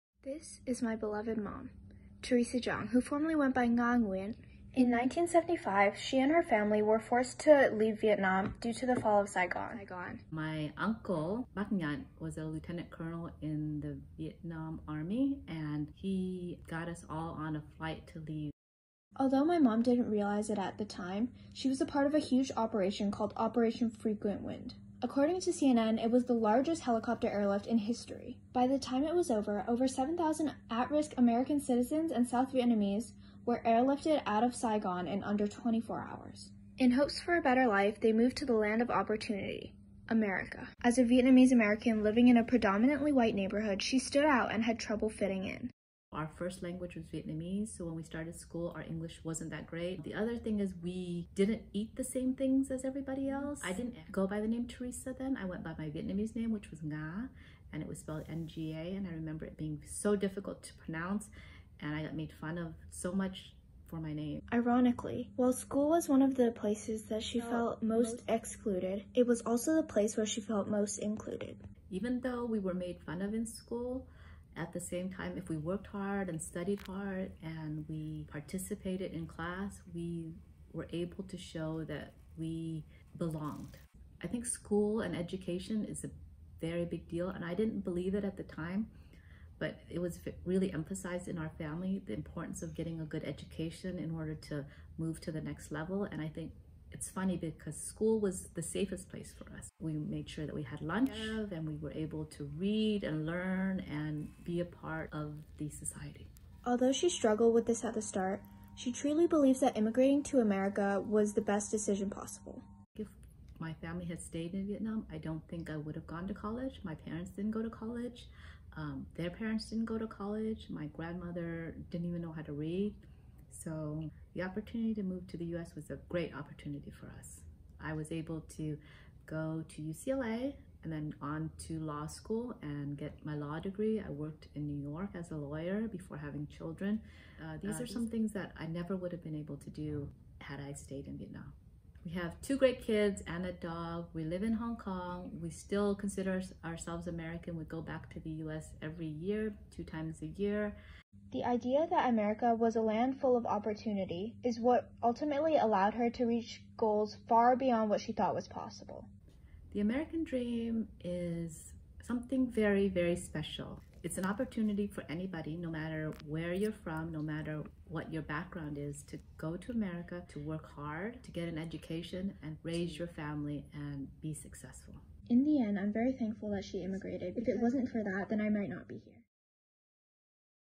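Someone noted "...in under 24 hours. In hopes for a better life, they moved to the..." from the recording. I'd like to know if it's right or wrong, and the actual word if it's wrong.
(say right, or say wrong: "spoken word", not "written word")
right.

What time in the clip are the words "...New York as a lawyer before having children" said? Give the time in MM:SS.
02:14.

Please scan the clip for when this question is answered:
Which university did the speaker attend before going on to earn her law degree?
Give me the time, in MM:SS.
02:09.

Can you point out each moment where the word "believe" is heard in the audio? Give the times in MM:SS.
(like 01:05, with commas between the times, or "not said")
01:27, 01:49.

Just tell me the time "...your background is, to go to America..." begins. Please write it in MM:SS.
02:48.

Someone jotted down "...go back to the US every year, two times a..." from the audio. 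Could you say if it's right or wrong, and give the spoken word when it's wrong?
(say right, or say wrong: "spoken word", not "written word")
right.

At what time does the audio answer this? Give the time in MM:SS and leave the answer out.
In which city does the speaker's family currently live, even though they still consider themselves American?
02:24.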